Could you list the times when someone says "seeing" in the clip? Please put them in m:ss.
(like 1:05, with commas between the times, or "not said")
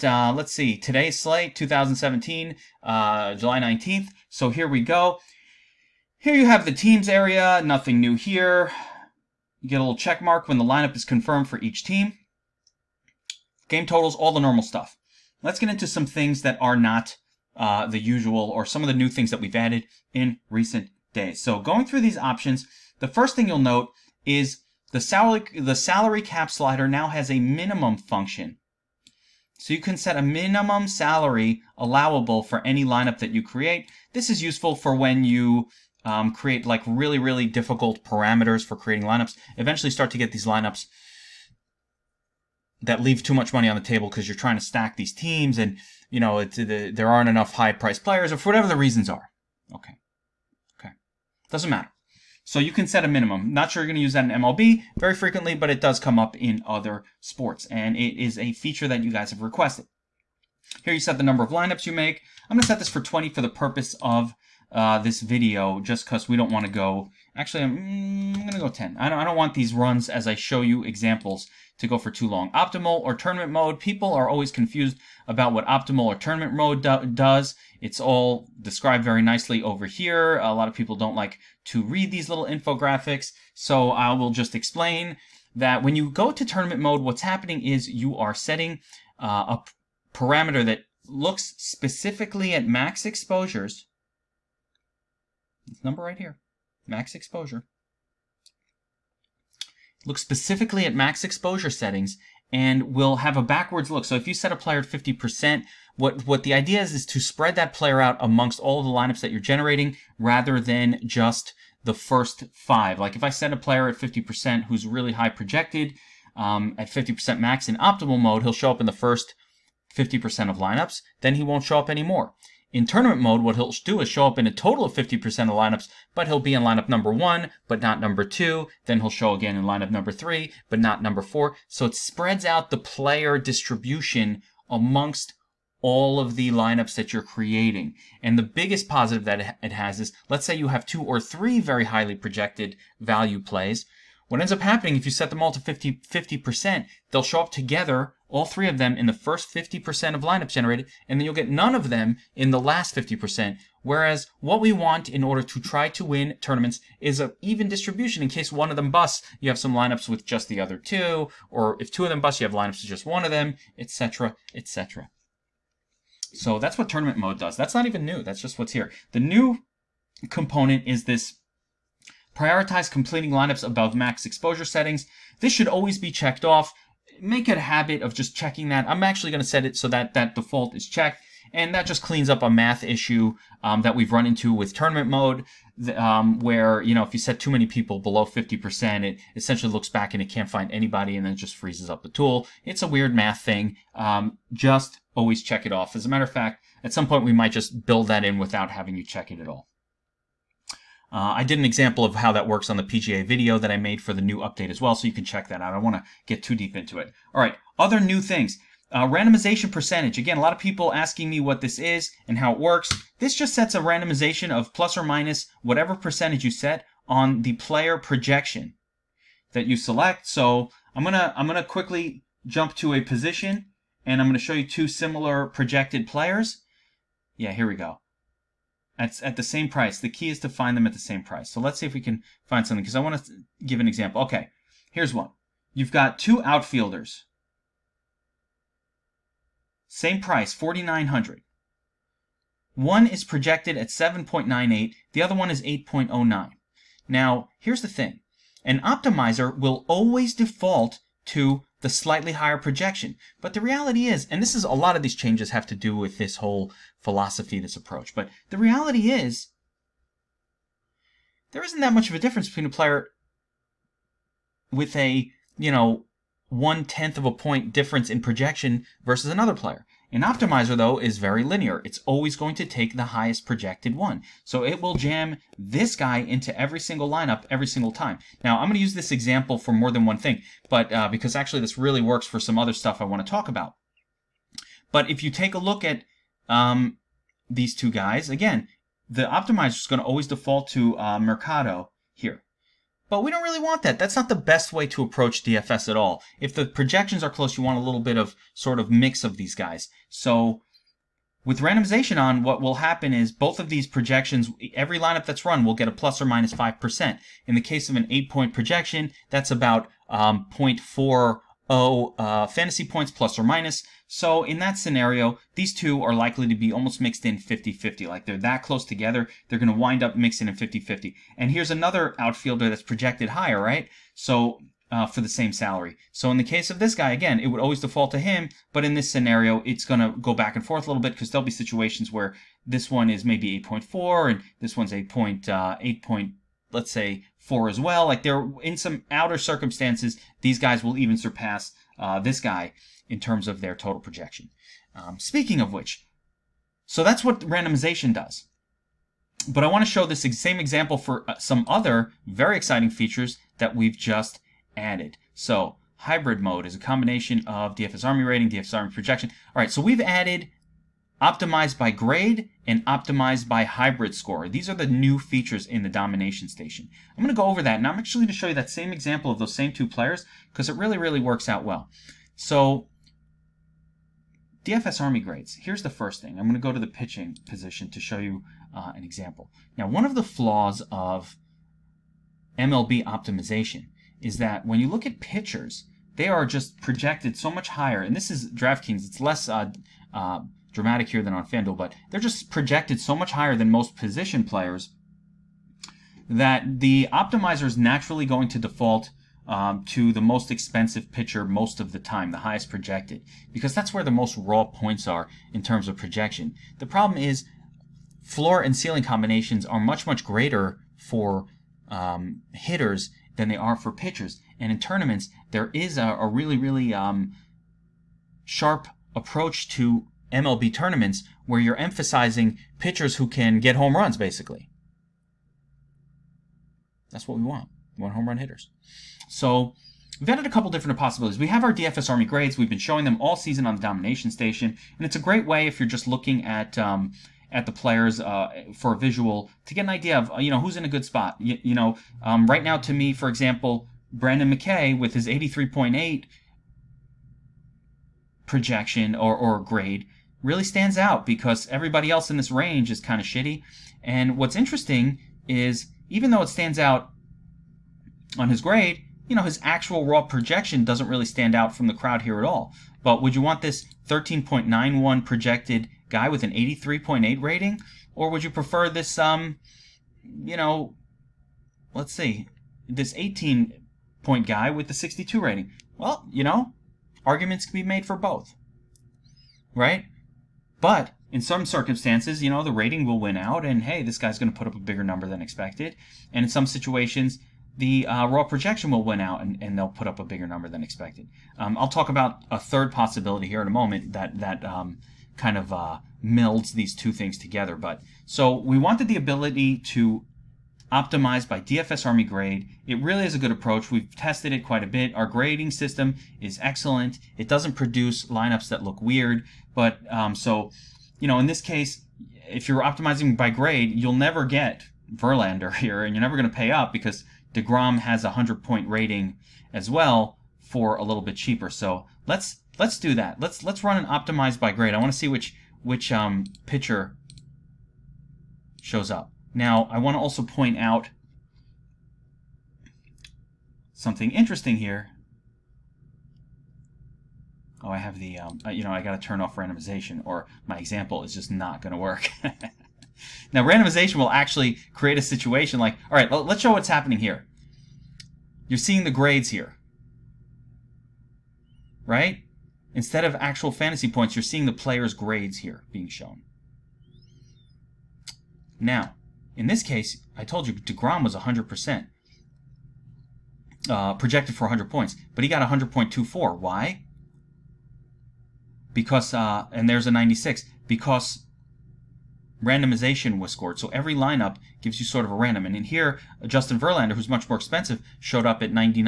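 9:08, 9:14.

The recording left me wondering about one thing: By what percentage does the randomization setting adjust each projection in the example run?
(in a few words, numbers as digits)
5%.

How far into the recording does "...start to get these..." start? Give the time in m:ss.
0:39.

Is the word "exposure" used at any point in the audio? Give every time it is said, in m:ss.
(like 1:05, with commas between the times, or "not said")
1:33, 1:37, 1:41, 2:54.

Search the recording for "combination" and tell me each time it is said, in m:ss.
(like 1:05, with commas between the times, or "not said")
5:56, 6:49.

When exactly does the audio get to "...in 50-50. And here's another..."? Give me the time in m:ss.
5:20.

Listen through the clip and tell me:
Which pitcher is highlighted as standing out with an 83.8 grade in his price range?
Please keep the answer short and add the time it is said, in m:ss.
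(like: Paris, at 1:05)
Brendan McKay, at 7:24.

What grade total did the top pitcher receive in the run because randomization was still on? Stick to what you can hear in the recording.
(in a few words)
100.24.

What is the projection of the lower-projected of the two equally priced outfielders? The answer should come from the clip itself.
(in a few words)
7.98.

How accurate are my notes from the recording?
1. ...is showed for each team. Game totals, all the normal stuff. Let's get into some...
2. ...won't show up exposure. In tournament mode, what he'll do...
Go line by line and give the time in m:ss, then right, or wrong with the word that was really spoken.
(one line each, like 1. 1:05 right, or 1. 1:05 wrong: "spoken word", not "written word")
1. 0:10 wrong: "confirmed", not "showed"
2. 2:01 wrong: "anymore", not "exposure".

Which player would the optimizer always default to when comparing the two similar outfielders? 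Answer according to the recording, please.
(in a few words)
Mercado.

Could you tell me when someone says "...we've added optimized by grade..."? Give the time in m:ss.
5:59.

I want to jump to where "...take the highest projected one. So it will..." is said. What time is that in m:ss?
4:32.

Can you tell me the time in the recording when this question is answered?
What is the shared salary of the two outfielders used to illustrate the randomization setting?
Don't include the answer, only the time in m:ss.
4:00.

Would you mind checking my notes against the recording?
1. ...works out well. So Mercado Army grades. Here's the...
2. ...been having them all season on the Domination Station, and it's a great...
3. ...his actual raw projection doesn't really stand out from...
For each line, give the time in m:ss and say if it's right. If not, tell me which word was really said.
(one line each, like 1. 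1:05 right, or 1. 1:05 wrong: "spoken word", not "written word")
1. 6:11 wrong: "DFS", not "Mercado"
2. 7:12 wrong: "showing", not "having"
3. 7:39 right.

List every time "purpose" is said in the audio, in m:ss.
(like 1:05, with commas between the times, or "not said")
1:03.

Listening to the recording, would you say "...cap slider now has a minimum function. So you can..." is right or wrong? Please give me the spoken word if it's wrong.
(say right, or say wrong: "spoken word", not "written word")
right.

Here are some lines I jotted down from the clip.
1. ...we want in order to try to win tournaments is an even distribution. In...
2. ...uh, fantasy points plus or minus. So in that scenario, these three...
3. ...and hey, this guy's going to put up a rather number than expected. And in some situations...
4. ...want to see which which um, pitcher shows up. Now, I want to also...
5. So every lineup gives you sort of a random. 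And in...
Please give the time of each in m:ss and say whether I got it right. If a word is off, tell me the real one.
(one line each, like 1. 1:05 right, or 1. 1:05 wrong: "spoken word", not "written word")
1. 2:34 right
2. 5:12 wrong: "two", not "three"
3. 8:03 wrong: "bigger", not "rather"
4. 8:44 right
5. 9:33 right.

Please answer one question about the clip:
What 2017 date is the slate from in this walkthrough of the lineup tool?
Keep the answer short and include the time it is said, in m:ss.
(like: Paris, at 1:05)
July 19th, at 0:03.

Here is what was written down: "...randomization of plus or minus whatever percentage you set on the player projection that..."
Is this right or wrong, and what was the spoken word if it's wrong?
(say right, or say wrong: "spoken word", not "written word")
right.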